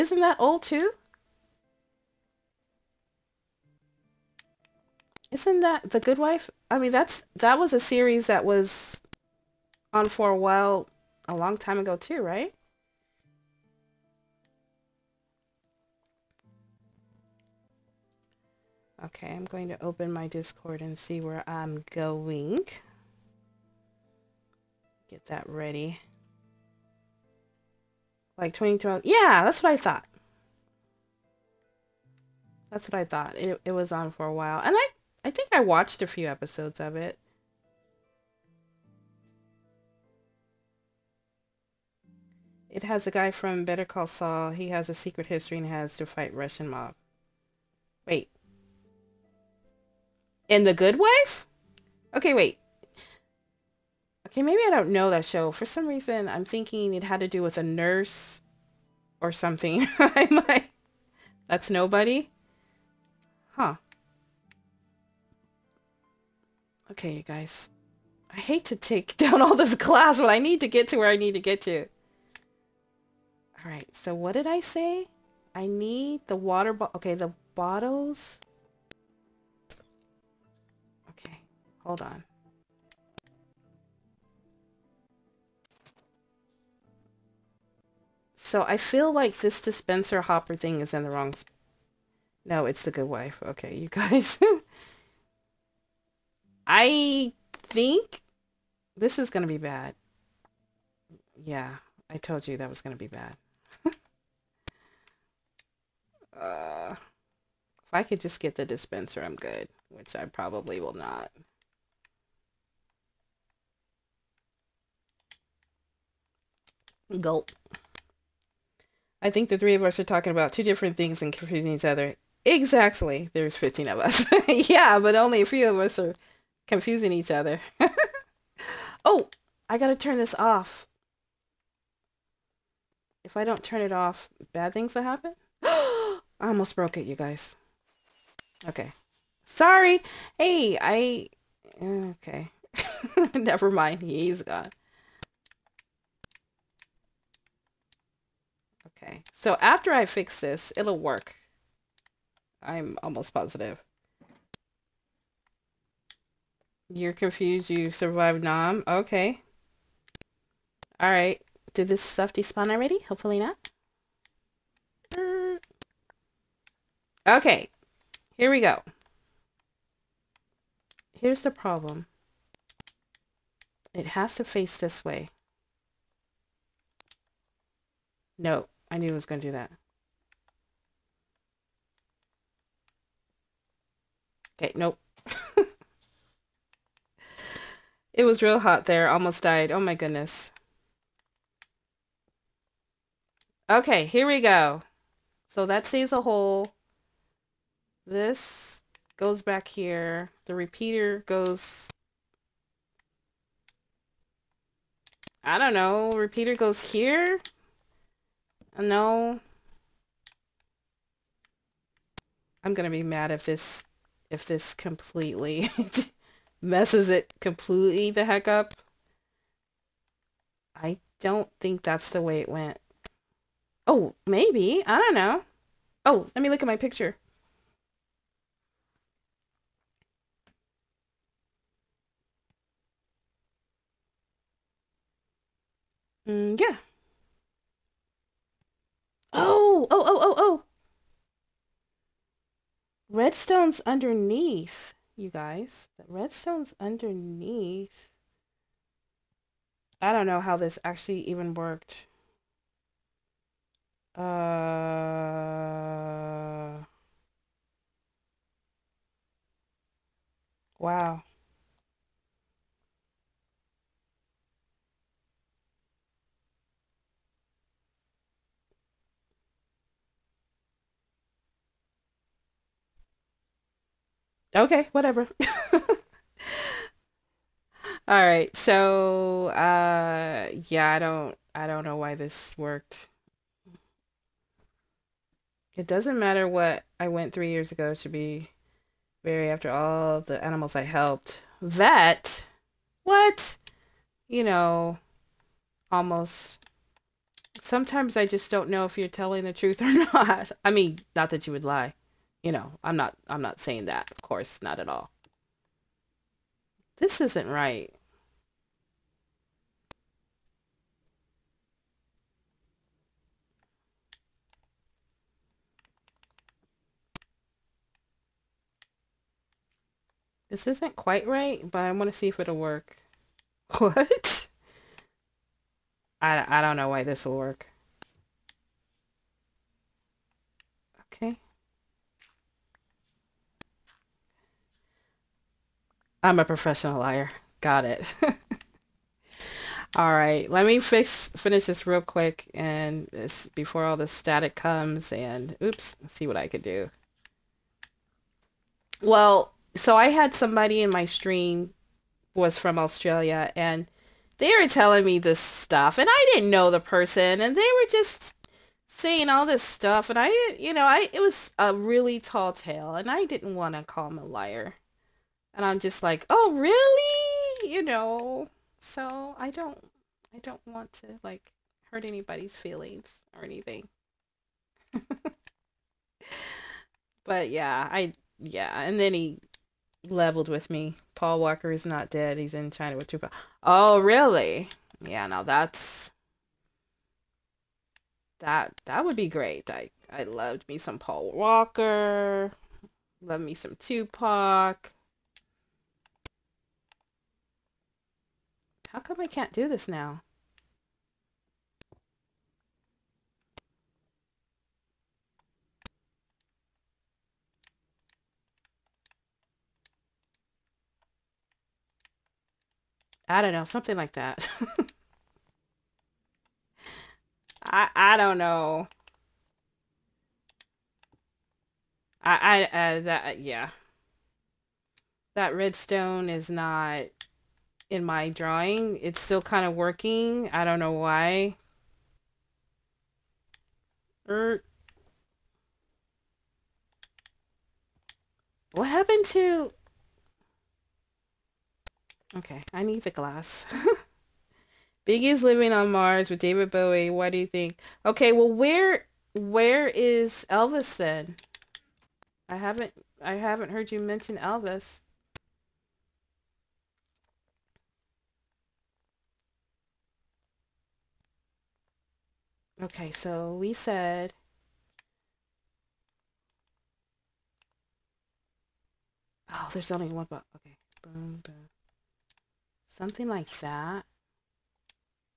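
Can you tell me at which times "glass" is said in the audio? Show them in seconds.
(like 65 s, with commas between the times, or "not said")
69 s, 443 s.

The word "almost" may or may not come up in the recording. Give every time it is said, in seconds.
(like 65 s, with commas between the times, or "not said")
136 s, 153 s, 189 s, 295 s.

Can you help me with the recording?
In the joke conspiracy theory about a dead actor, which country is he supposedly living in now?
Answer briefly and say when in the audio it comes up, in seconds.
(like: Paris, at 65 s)
China, at 382 s.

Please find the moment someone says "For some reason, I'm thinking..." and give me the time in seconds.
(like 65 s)
55 s.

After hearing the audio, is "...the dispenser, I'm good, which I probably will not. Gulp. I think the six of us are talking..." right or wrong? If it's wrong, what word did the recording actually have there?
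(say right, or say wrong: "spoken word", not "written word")
wrong: "three", not "six".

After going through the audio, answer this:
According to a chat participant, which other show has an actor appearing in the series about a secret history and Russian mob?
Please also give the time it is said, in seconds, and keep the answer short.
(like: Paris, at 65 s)
Better Call Saul, at 43 s.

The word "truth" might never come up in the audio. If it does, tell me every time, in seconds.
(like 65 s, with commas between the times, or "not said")
299 s.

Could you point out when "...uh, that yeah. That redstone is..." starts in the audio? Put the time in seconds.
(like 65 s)
422 s.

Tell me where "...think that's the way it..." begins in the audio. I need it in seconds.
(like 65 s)
221 s.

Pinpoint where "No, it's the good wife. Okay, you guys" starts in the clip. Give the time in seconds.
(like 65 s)
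92 s.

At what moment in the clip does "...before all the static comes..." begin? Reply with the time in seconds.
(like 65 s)
343 s.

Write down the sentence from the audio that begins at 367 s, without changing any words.
You know, so I don't, I don't want to like hurt anybody's feelings or anything.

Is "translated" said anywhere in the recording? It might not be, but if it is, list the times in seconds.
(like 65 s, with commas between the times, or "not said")
not said.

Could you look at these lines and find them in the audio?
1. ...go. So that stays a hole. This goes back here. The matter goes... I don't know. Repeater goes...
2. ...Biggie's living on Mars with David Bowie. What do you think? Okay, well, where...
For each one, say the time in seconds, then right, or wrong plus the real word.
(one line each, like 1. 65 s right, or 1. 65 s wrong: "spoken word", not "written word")
1. 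194 s wrong: "repeater", not "matter"
2. 445 s right.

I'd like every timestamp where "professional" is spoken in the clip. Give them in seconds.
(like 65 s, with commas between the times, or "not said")
336 s.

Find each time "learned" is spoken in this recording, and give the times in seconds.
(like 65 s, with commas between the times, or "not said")
not said.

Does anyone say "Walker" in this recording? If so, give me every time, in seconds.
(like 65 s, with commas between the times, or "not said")
381 s, 391 s.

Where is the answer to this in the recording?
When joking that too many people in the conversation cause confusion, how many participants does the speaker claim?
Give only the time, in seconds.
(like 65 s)
123 s.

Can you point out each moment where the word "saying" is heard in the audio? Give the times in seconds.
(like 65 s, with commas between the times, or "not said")
303 s, 358 s.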